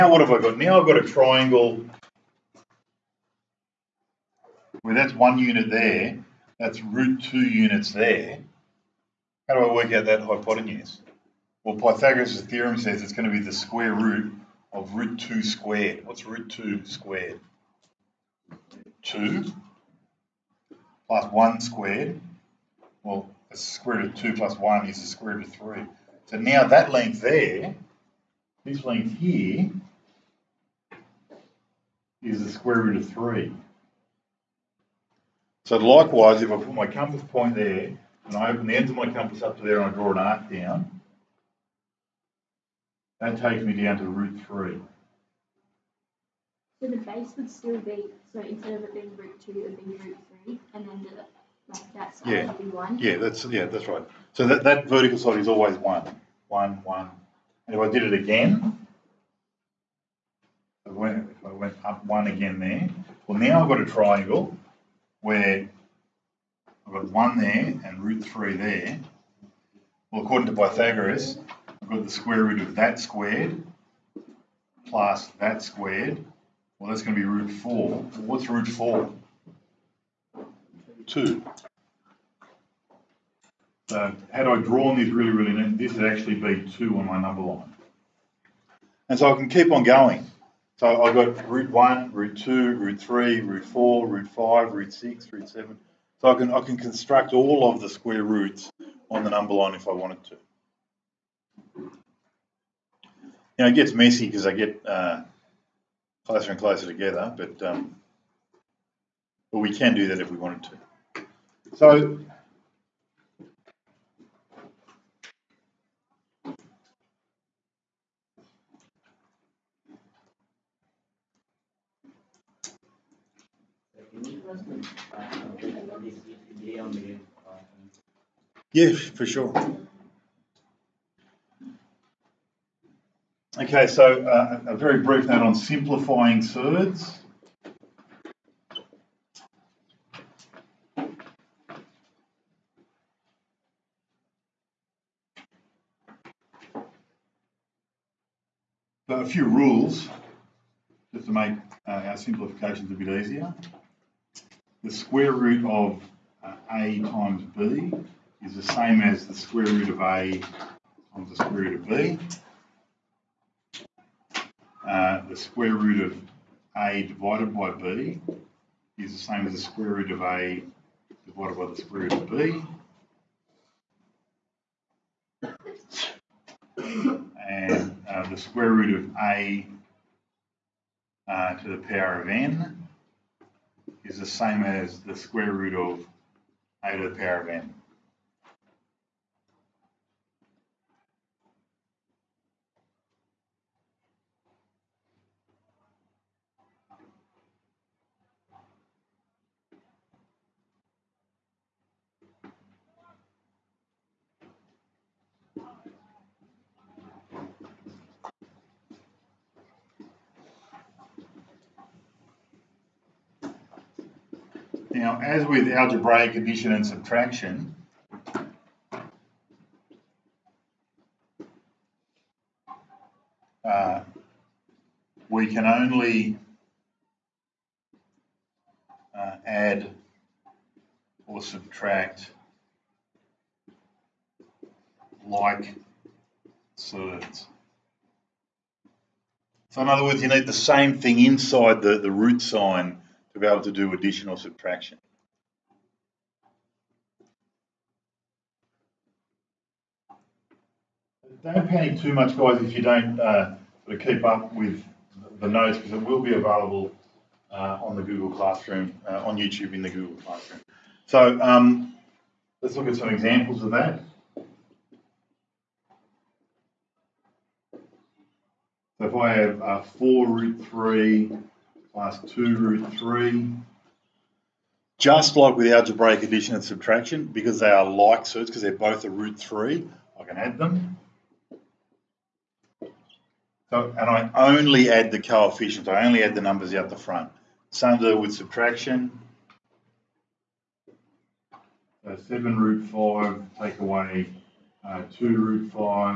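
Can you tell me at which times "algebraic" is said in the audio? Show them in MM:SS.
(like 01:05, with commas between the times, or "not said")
03:35, 04:35.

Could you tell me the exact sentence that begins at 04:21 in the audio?
So um, let's look at some examples of that.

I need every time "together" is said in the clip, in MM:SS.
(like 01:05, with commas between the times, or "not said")
01:46.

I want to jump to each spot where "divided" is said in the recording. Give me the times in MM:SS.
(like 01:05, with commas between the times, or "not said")
02:47, 02:51.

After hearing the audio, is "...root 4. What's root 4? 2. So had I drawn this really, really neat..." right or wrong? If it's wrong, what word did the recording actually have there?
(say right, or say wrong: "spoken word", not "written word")
right.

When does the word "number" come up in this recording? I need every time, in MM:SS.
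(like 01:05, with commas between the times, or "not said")
01:27, 01:39, 04:46.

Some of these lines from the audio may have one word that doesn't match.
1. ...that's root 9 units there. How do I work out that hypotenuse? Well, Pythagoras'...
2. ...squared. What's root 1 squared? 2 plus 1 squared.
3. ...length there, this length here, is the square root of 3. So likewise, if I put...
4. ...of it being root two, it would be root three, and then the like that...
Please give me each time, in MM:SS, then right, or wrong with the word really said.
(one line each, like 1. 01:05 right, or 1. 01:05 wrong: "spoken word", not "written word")
1. 00:06 wrong: "2", not "9"
2. 00:15 wrong: "2", not "1"
3. 00:26 right
4. 00:48 right.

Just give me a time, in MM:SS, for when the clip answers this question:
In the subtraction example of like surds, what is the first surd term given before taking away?
04:52.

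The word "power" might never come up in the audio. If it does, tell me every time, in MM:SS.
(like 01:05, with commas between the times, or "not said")
03:01, 03:07.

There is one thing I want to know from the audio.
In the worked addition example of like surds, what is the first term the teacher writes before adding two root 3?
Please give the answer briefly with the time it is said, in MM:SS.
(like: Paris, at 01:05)
4 root 3, at 04:29.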